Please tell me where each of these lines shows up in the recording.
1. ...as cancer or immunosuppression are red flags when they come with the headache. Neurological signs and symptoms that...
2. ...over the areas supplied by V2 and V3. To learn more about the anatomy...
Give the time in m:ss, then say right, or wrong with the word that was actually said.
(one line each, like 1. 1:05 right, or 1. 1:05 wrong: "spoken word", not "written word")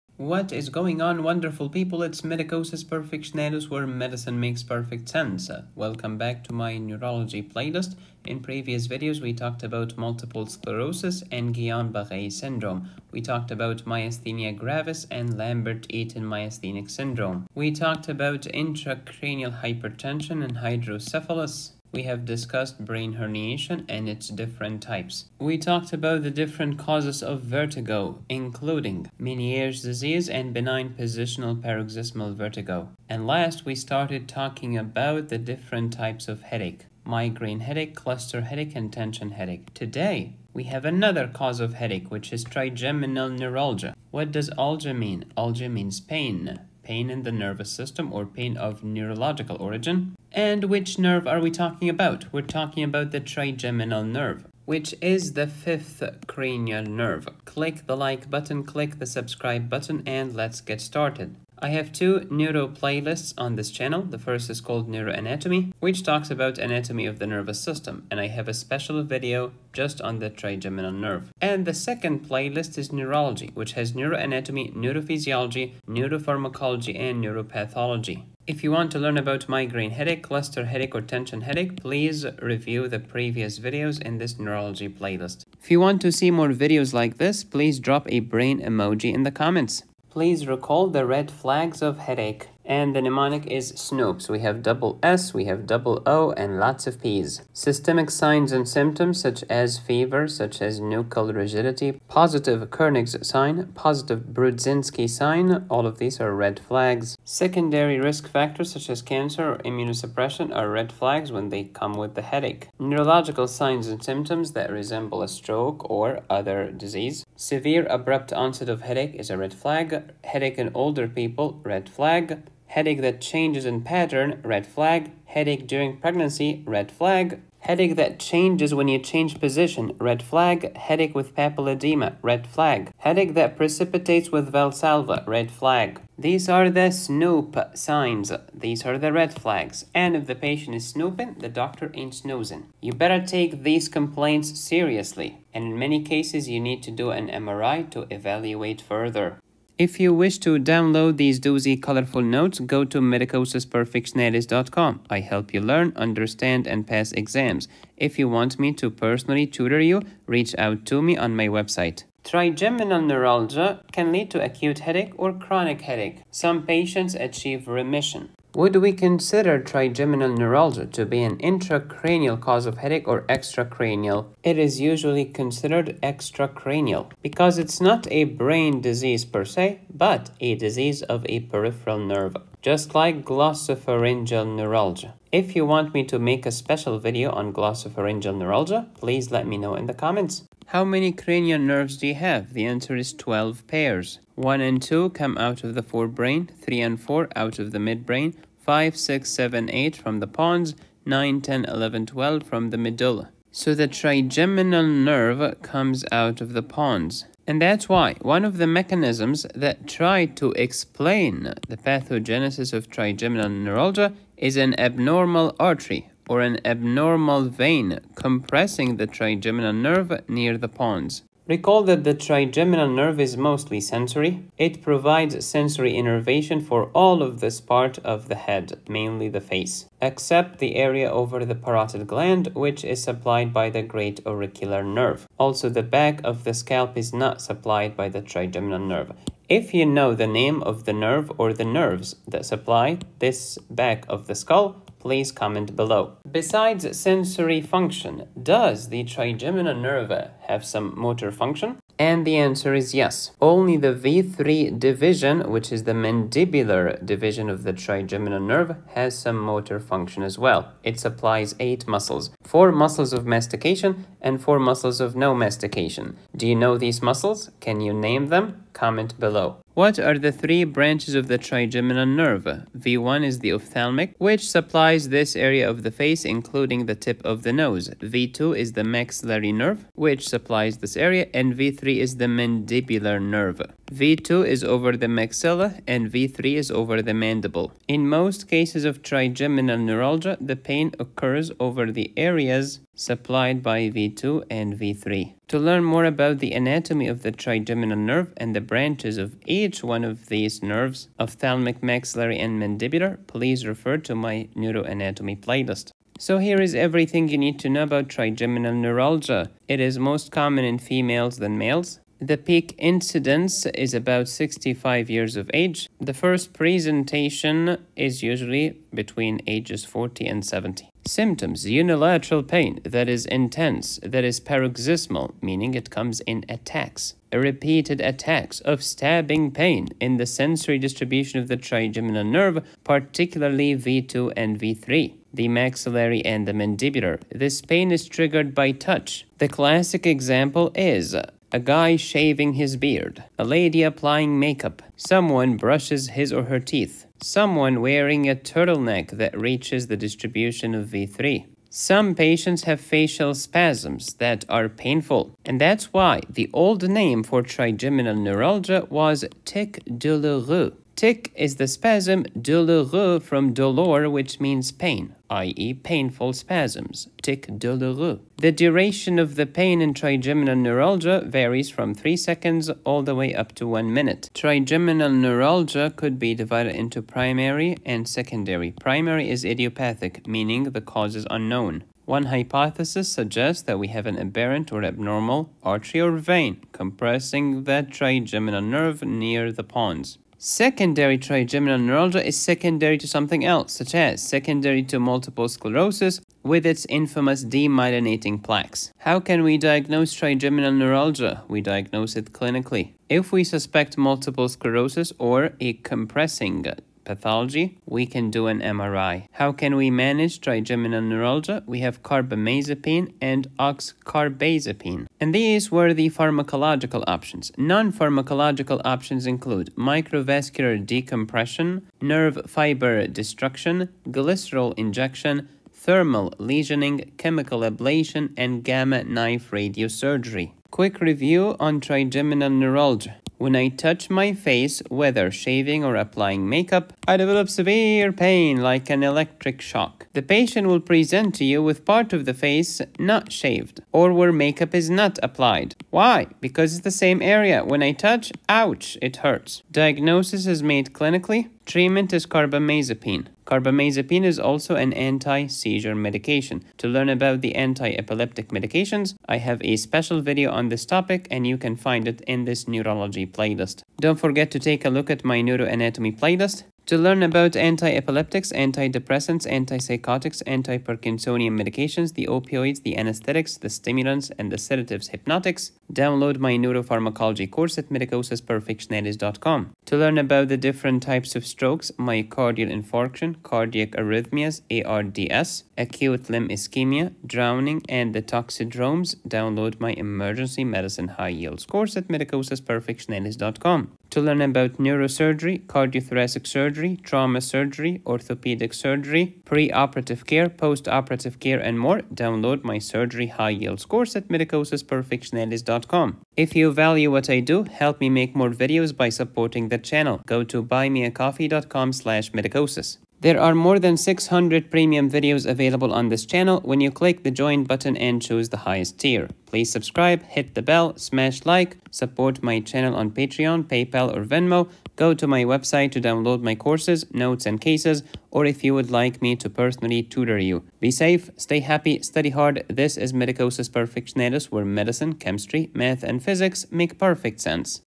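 1. 1:48 right
2. 4:51 right.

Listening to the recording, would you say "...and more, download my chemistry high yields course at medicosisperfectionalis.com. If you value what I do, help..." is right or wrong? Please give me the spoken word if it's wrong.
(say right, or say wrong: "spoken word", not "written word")
wrong: "surgery", not "chemistry".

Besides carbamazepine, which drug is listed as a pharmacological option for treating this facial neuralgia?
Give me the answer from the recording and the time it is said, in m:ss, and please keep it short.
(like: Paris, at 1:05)
oxcarbazepine, at 6:53.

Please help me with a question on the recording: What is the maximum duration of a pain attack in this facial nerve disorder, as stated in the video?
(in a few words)
1 minute.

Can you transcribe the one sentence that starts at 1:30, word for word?
Please recall the red flags of headache.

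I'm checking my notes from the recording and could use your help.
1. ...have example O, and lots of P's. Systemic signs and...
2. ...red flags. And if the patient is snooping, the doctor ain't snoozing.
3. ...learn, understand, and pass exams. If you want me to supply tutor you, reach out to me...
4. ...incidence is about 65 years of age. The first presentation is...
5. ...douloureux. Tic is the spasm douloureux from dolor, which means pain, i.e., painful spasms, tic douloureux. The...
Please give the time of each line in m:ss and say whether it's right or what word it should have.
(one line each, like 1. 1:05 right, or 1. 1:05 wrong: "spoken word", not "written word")
1. 1:35 wrong: "double", not "example"
2. 2:19 right
3. 2:35 wrong: "personally", not "supply"
4. 5:12 right
5. 5:59 right.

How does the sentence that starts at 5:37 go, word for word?
This pain is triggered by touch.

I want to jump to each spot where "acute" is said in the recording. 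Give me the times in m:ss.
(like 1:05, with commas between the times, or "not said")
2:44, 8:05.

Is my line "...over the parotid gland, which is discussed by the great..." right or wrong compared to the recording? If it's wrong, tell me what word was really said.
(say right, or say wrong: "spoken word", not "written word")
wrong: "supplied", not "discussed".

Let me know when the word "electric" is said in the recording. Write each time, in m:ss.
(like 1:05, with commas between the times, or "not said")
7:19.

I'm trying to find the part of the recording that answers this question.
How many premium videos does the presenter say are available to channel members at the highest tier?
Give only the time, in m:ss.
8:33.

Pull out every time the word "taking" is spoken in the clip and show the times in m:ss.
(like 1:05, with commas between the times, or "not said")
not said.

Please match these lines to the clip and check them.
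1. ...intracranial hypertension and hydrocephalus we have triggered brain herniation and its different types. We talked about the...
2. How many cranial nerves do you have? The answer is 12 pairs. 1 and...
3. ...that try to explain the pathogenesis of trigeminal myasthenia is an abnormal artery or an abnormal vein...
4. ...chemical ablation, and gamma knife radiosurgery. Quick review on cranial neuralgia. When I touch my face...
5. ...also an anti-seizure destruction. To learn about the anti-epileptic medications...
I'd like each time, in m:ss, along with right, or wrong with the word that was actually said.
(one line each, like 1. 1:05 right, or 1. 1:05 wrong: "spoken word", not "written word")
1. 0:18 wrong: "discussed", not "triggered"
2. 3:10 right
3. 3:29 wrong: "neuralgia", not "myasthenia"
4. 7:07 wrong: "trigeminal", not "cranial"
5. 7:34 wrong: "medication", not "destruction".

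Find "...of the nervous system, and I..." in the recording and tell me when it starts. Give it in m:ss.
1:07.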